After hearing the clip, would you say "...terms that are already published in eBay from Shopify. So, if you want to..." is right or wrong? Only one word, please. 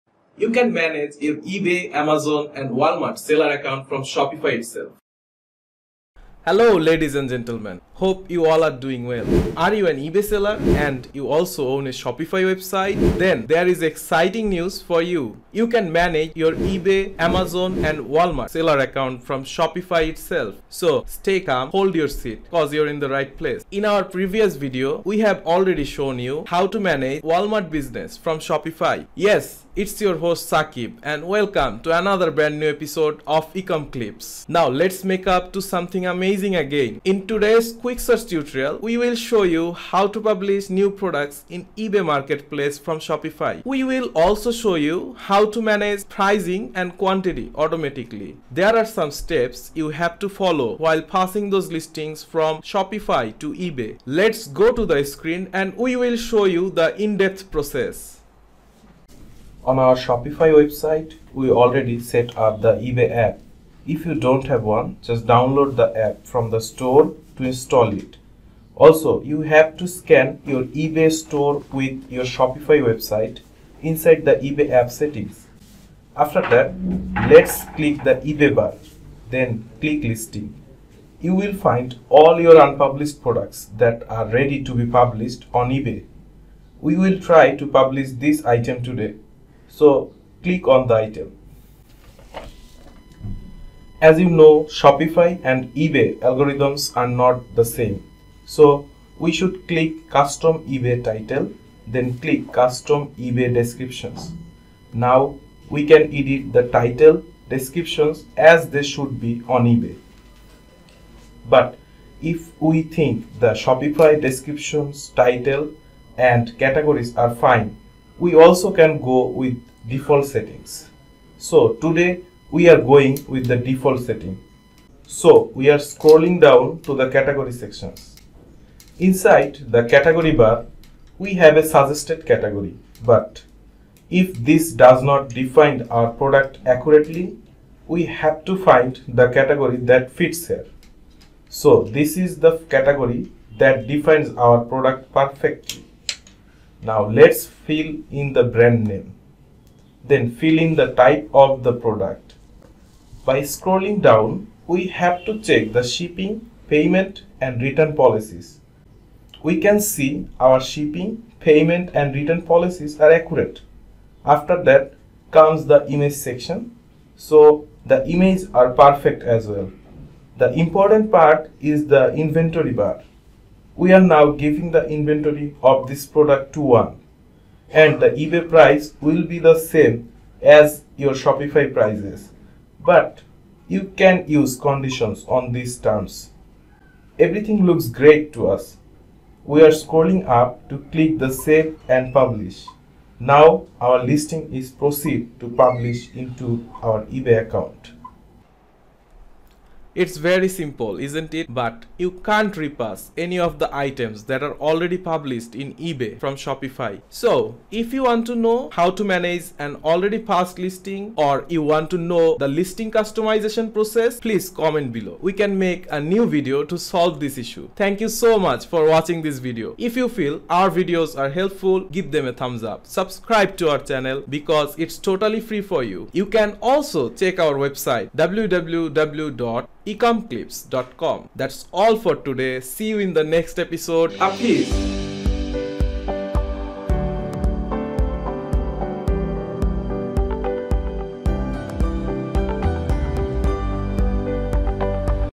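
wrong.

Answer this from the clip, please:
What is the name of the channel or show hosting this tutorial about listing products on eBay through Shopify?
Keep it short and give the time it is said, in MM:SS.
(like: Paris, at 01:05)
Ecom Clips, at 00:33.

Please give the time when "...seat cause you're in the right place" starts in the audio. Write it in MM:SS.
00:22.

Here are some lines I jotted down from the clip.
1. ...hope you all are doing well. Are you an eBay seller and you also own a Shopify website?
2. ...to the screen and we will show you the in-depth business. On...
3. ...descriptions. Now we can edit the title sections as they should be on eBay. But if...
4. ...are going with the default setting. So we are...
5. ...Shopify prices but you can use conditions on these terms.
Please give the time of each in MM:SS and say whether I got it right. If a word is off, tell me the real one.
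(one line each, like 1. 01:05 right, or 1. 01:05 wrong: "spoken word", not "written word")
1. 00:07 right
2. 00:54 wrong: "process", not "business"
3. 01:43 wrong: "descriptions", not "sections"
4. 02:02 right
5. 03:01 right.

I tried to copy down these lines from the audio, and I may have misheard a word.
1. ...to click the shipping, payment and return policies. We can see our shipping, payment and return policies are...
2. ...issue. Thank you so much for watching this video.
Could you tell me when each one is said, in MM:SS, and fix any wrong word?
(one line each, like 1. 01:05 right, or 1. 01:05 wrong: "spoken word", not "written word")
1. 02:35 wrong: "check", not "click"
2. 03:37 right.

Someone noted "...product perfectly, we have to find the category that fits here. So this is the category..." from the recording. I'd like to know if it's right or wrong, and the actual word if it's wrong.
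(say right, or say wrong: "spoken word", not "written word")
wrong: "accurately", not "perfectly".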